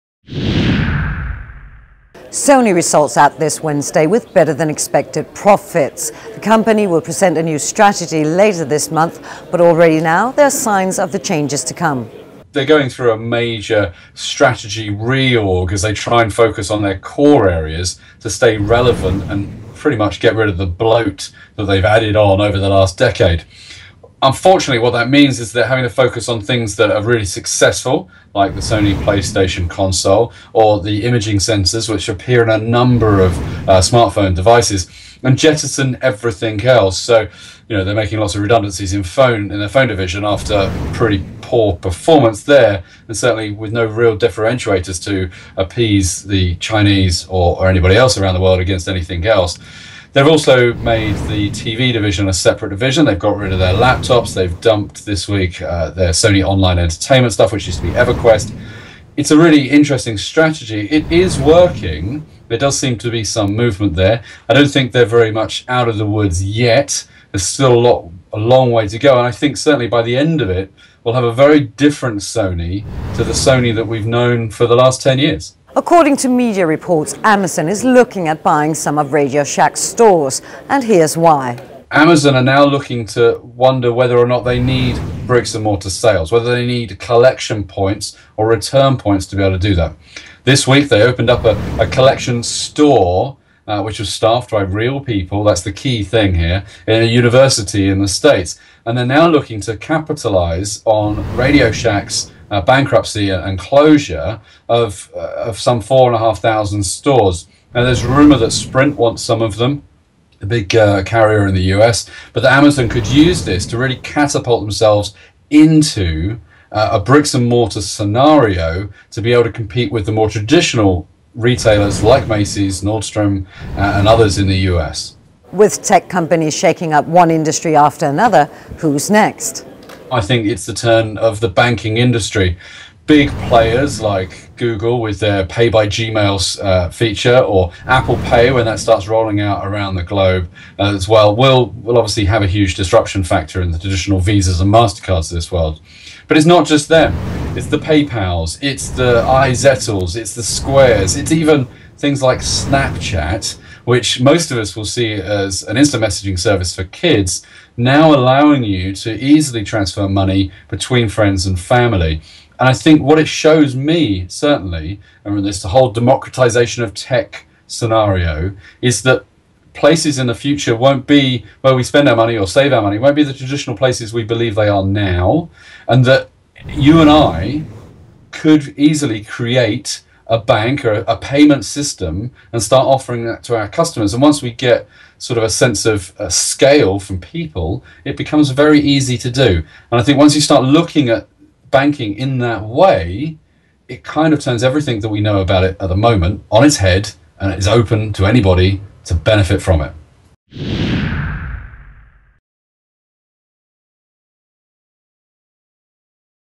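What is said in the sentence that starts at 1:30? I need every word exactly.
This week they opened up a, a collection store uh, which was staffed by real people.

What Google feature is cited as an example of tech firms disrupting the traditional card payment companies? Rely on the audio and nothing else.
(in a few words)
Pay by Gmail.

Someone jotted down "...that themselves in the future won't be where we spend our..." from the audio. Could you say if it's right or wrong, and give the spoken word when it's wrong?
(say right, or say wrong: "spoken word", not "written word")
wrong: "places", not "themselves".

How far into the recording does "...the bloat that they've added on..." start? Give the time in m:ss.
0:20.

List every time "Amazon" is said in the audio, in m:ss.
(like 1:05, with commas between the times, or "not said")
1:17, 1:21, 1:52.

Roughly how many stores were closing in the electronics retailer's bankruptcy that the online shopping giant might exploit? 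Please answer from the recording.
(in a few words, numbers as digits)
4,500.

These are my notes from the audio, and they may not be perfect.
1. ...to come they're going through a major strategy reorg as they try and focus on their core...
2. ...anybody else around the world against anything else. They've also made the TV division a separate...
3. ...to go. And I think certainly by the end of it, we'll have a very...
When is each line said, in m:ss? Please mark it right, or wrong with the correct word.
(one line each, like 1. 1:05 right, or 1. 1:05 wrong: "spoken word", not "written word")
1. 0:11 right
2. 0:47 right
3. 1:08 right.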